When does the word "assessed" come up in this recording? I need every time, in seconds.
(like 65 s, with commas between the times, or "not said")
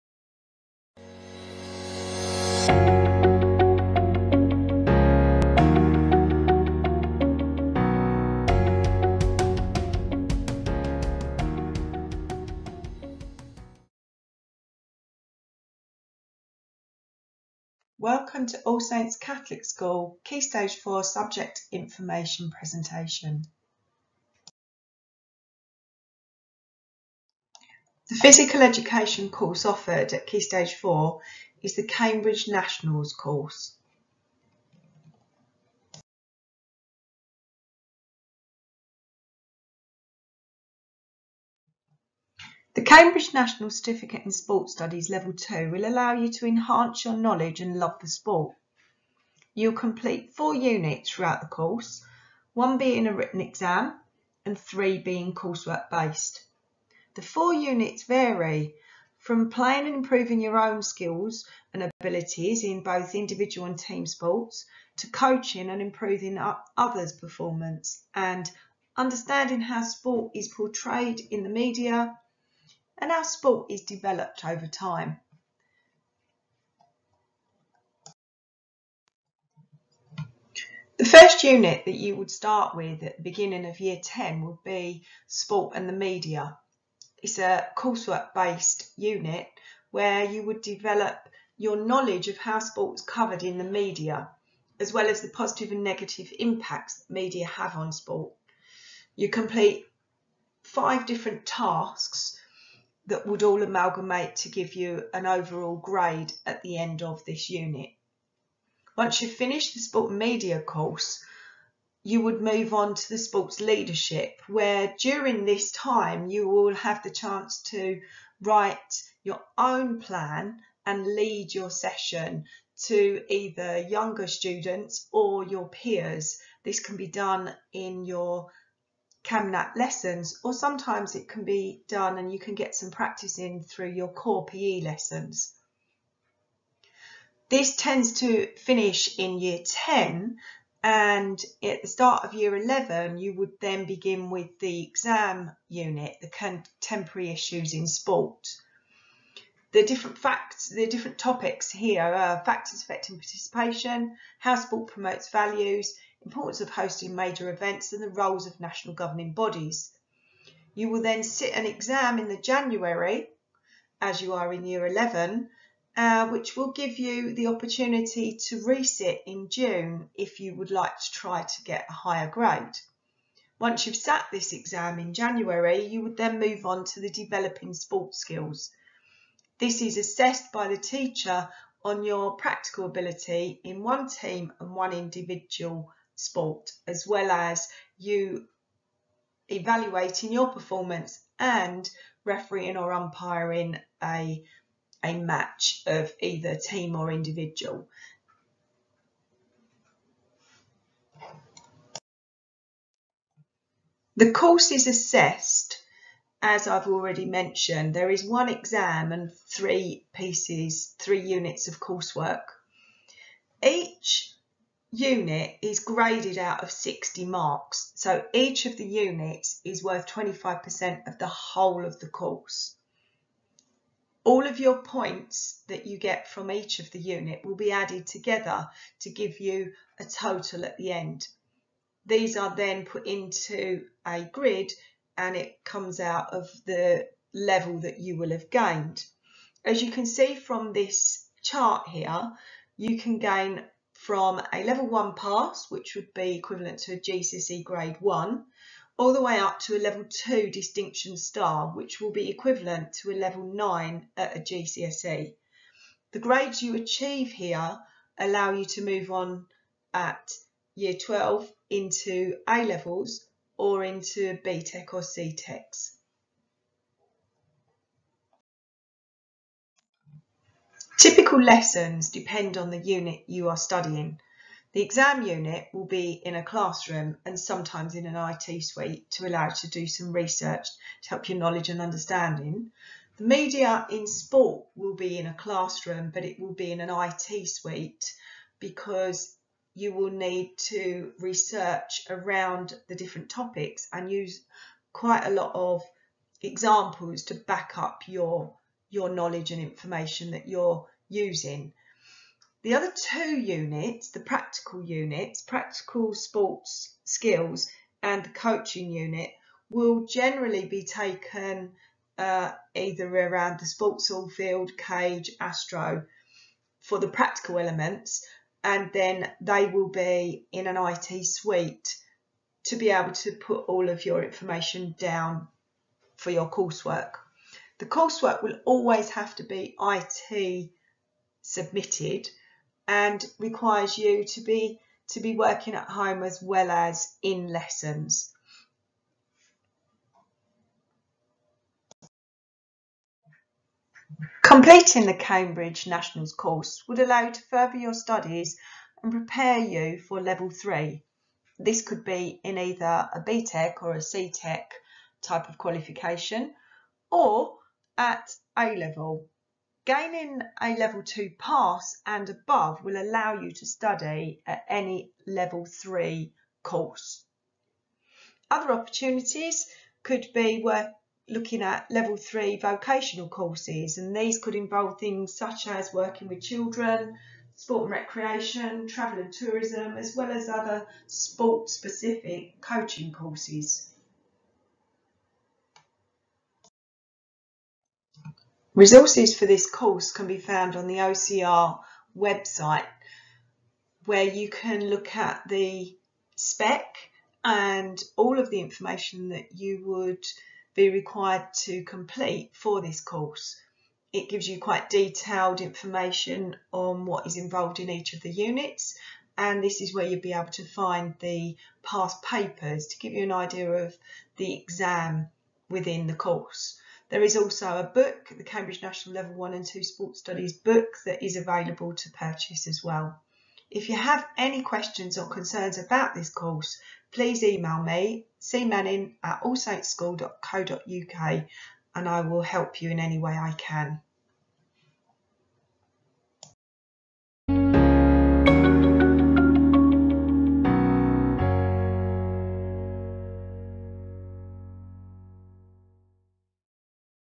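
179 s, 204 s.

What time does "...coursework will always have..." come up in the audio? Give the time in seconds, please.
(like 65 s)
327 s.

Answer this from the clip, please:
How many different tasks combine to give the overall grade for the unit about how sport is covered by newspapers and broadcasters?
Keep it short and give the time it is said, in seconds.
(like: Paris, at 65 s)
5, at 100 s.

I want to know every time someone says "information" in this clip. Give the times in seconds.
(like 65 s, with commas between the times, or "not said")
21 s, 299 s, 324 s, 398 s, 405 s.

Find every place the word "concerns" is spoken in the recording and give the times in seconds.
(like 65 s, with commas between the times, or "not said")
425 s.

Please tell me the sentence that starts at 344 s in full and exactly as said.
Completing the Cambridge Nationals course would allow you to further your studies and prepare you for level three.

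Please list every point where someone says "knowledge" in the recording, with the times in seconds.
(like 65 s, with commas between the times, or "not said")
47 s, 91 s, 281 s, 299 s.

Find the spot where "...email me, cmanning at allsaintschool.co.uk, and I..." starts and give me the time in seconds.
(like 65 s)
427 s.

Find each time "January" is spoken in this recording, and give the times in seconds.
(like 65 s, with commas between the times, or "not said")
162 s, 175 s.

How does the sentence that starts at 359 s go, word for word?
Gaining a level two pass and above will allow you to study at any level three course.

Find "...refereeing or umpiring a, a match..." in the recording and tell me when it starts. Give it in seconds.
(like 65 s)
192 s.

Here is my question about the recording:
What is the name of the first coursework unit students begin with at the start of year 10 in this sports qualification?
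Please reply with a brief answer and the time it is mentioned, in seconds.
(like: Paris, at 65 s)
Sport and the media, at 85 s.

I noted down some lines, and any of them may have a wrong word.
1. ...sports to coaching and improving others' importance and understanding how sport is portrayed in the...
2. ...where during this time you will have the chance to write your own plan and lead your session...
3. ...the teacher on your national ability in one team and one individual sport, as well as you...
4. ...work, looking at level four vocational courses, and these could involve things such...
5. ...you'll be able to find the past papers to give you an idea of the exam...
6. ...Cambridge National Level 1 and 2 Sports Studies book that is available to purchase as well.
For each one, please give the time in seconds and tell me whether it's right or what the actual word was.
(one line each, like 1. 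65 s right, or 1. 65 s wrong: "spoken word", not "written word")
1. 64 s wrong: "performance", not "importance"
2. 114 s right
3. 180 s wrong: "practical", not "national"
4. 370 s wrong: "three", not "four"
5. 410 s right
6. 418 s right.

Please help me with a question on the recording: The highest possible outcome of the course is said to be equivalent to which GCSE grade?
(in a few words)
9.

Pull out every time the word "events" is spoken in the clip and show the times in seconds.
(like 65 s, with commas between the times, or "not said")
157 s.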